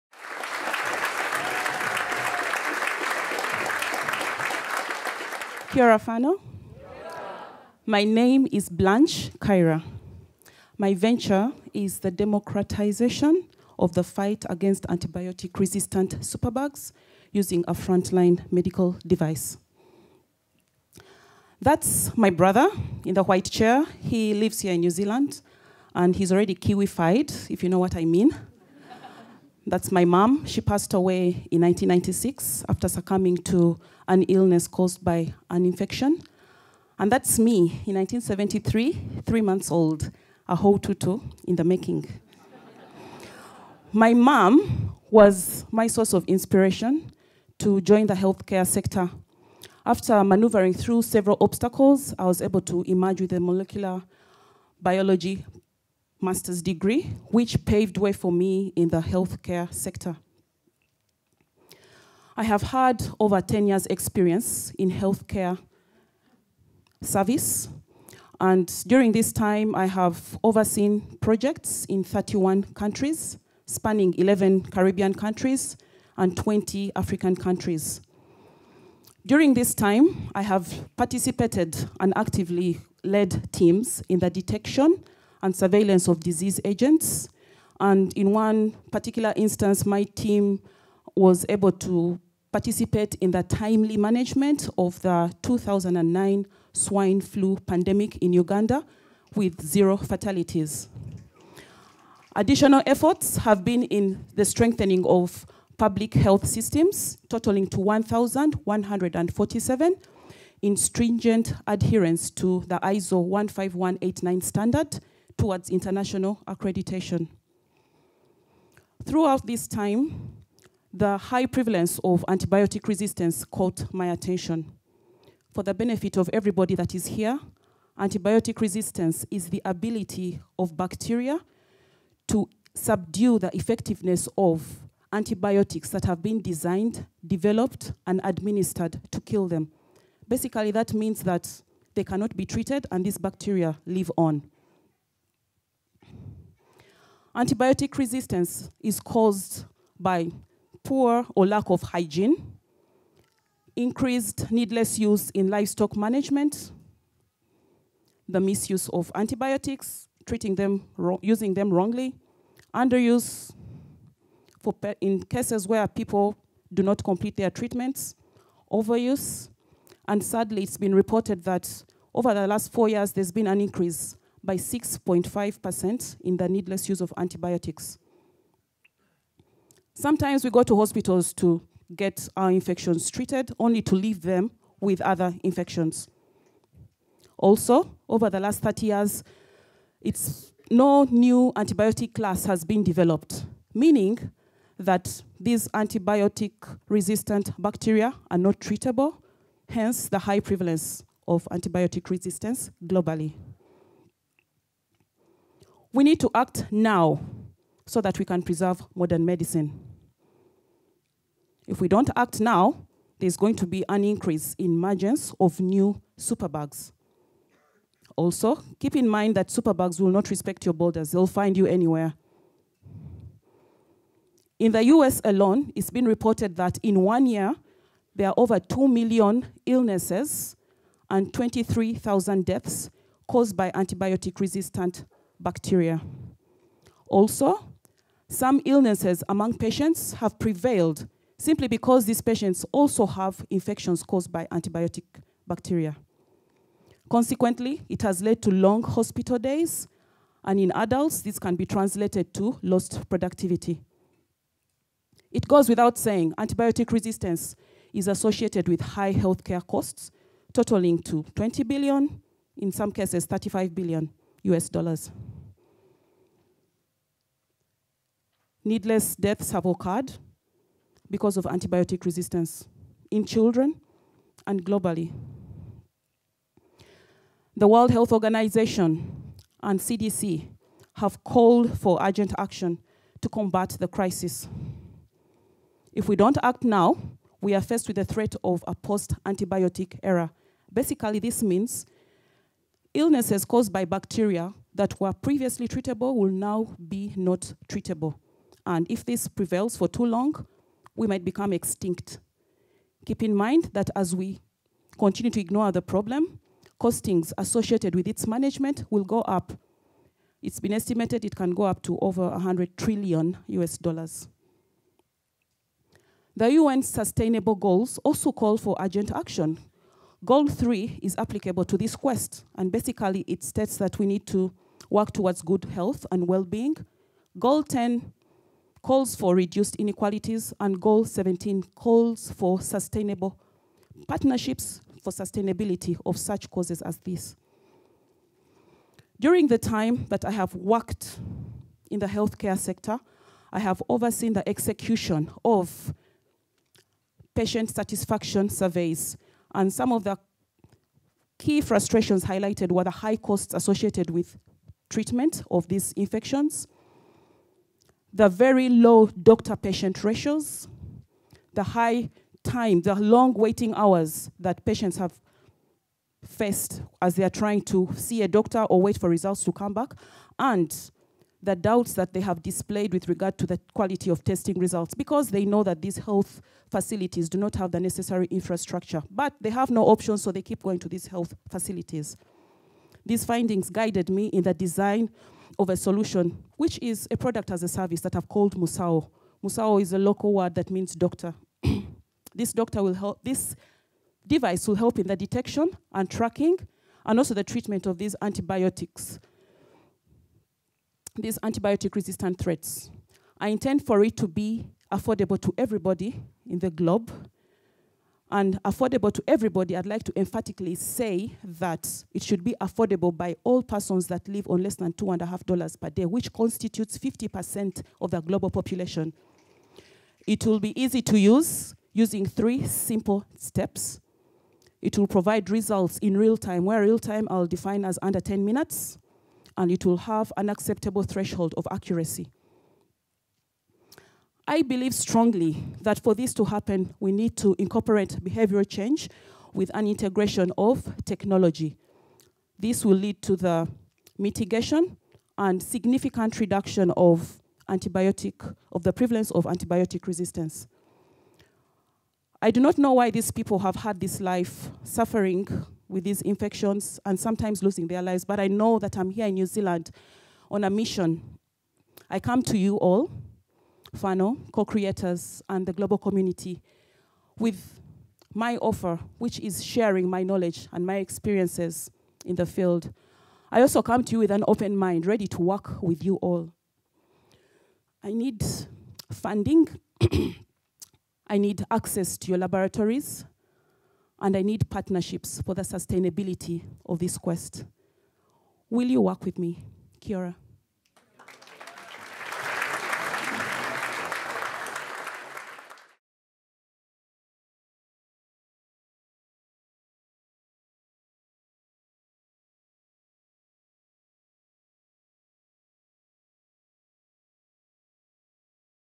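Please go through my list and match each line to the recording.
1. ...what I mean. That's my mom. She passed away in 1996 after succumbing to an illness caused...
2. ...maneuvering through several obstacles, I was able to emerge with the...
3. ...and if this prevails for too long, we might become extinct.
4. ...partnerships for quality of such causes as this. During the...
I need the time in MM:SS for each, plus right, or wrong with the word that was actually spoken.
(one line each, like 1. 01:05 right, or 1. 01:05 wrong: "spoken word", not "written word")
1. 00:27 right
2. 00:50 right
3. 04:58 right
4. 05:34 wrong: "sustainability", not "quality".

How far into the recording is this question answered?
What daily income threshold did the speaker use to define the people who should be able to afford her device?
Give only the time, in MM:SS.
06:54.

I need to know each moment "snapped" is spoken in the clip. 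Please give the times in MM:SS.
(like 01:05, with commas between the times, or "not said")
not said.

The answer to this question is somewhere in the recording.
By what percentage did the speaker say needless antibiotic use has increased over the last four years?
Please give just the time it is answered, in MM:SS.
02:54.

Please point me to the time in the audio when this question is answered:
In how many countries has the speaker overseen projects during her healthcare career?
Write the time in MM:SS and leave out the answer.
01:12.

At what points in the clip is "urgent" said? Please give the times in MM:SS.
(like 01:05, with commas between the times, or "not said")
04:42, 05:18.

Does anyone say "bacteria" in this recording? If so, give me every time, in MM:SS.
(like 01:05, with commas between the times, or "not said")
02:10, 02:23, 03:17, 03:55, 04:05, 04:53.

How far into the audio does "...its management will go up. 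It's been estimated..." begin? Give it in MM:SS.
05:08.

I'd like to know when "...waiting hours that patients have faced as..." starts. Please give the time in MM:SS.
06:03.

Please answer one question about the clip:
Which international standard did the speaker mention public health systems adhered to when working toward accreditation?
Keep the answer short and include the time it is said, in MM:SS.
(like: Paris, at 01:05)
ISO 15189, at 01:52.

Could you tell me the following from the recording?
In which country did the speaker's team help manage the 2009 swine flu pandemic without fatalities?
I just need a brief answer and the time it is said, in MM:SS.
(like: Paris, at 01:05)
Uganda, at 01:38.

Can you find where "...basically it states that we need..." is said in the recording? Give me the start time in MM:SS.
05:22.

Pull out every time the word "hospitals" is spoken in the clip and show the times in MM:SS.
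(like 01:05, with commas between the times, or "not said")
03:00, 04:08.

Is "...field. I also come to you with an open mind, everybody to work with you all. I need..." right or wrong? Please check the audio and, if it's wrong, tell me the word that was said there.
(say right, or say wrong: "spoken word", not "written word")
wrong: "ready", not "everybody".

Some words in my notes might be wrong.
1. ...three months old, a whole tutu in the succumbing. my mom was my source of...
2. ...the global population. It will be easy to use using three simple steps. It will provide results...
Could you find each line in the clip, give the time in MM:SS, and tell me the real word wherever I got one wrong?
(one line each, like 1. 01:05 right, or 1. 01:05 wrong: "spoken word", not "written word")
1. 00:39 wrong: "making", not "succumbing"
2. 06:58 right.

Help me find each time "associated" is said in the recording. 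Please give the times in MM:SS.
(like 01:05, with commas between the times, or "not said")
04:18, 05:07, 05:53.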